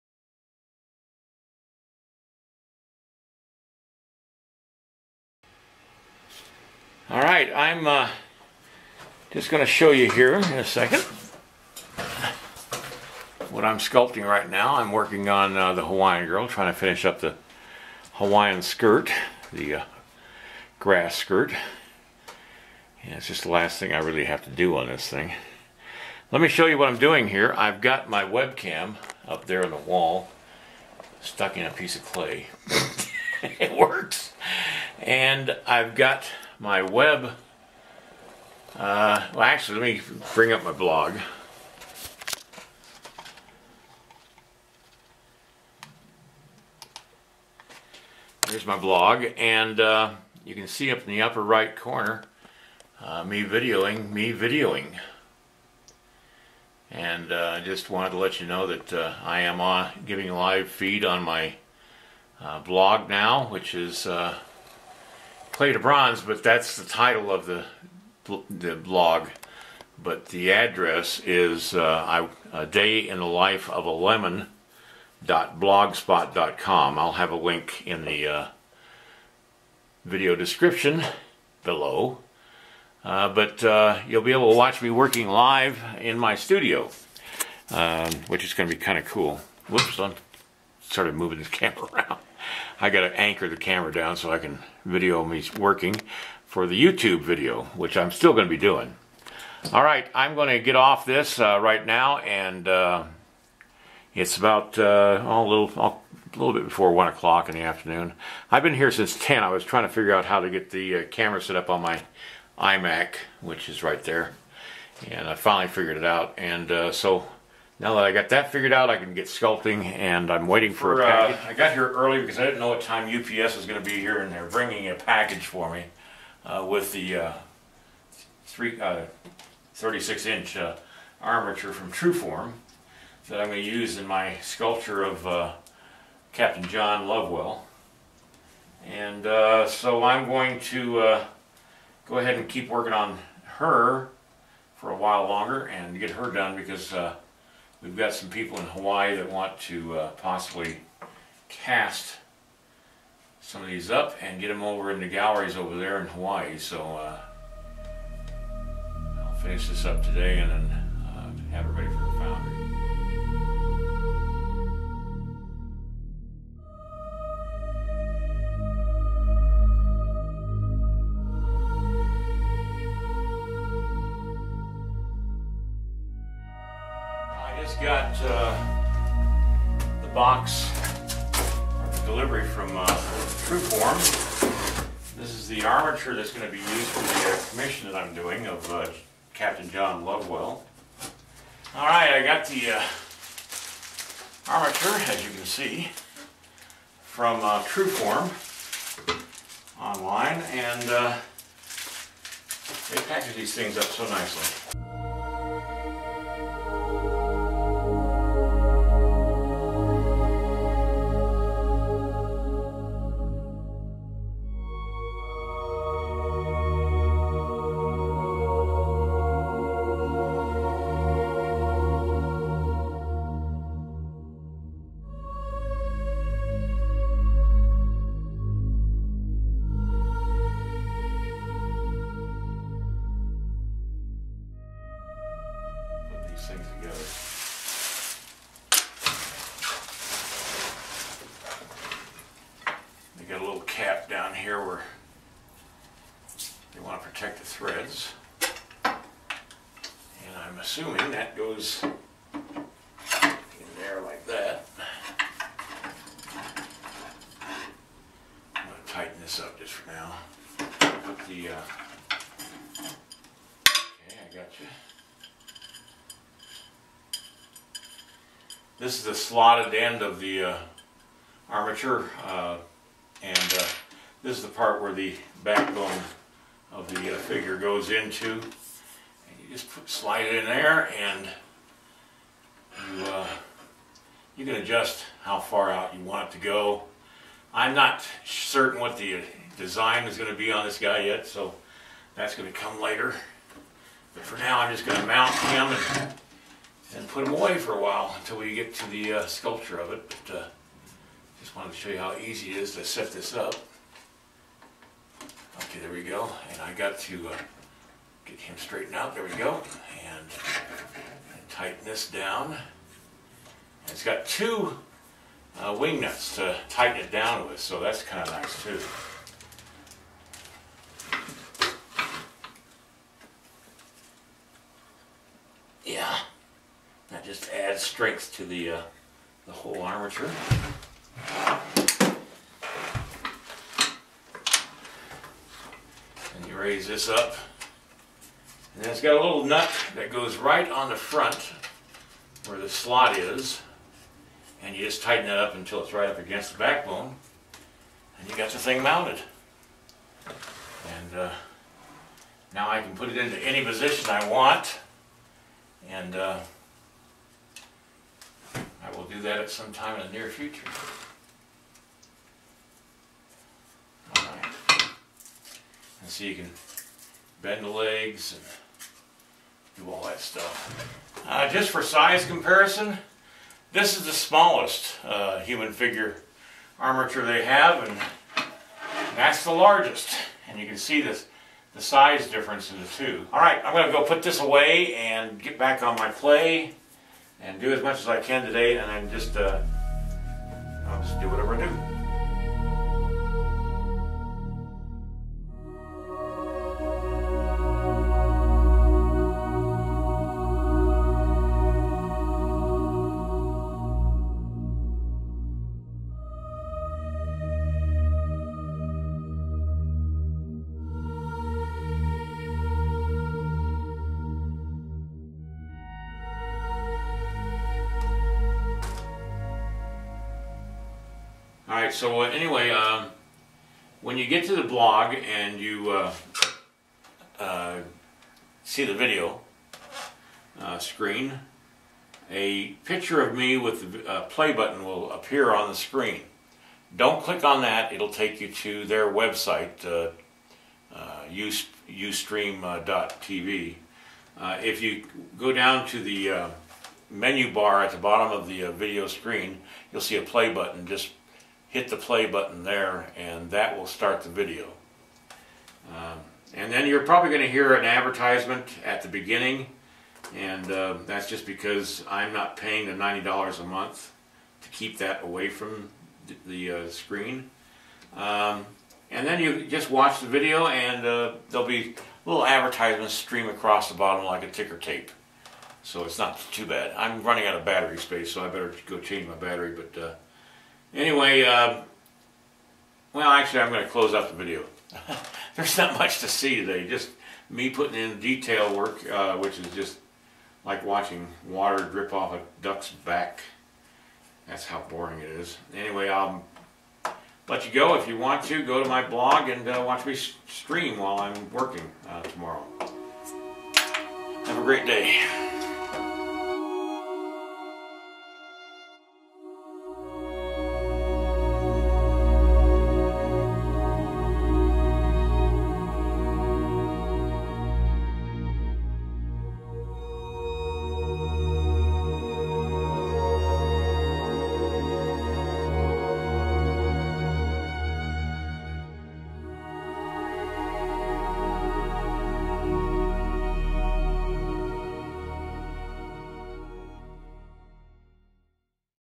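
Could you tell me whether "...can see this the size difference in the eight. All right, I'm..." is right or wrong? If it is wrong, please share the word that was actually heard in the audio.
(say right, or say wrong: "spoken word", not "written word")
wrong: "two", not "eight".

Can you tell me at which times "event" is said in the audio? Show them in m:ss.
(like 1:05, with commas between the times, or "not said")
not said.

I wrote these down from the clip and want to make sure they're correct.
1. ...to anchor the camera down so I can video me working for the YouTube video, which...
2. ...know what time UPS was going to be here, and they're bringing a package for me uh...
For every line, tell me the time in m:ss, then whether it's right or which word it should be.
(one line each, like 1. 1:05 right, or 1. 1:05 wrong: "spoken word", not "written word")
1. 1:33 right
2. 2:02 right.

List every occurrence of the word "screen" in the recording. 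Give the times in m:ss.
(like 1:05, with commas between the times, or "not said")
7:10, 7:15, 7:29, 7:46.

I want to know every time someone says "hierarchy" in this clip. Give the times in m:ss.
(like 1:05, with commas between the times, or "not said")
not said.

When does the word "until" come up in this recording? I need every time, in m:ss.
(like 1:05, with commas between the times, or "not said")
4:58, 5:45.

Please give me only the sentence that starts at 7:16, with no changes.
Don't click on that, it'll take you to their website, uh, uh ustream.tv.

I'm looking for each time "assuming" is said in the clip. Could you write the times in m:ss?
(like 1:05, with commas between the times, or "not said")
4:10.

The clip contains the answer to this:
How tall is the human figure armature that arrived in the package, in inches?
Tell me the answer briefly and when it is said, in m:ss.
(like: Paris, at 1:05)
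36, at 2:09.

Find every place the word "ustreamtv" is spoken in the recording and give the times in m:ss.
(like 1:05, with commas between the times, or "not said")
7:21.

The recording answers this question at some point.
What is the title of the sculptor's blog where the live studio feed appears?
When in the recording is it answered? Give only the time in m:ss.
1:05.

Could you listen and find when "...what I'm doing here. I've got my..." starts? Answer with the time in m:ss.
0:26.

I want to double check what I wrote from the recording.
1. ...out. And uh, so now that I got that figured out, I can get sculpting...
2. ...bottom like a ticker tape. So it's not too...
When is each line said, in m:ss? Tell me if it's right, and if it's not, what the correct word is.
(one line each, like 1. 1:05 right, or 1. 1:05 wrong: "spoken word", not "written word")
1. 1:56 right
2. 7:53 right.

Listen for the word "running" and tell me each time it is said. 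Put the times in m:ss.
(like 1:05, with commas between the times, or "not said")
7:57.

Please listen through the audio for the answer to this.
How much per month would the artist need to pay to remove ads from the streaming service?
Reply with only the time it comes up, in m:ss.
7:43.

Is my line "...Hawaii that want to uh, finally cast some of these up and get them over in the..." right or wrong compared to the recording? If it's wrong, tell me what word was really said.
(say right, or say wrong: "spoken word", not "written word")
wrong: "possibly", not "finally".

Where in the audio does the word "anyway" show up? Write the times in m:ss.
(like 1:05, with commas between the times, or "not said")
7:02, 8:00, 8:15.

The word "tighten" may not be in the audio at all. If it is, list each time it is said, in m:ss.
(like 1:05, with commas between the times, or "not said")
4:18, 5:11, 5:16, 5:45.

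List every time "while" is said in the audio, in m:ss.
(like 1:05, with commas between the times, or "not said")
2:24, 4:57, 8:20.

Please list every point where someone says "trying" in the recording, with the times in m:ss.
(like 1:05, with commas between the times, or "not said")
0:16, 1:49.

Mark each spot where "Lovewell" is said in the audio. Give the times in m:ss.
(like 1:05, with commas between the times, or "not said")
2:17, 3:10.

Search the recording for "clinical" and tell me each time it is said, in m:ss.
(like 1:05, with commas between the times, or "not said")
not said.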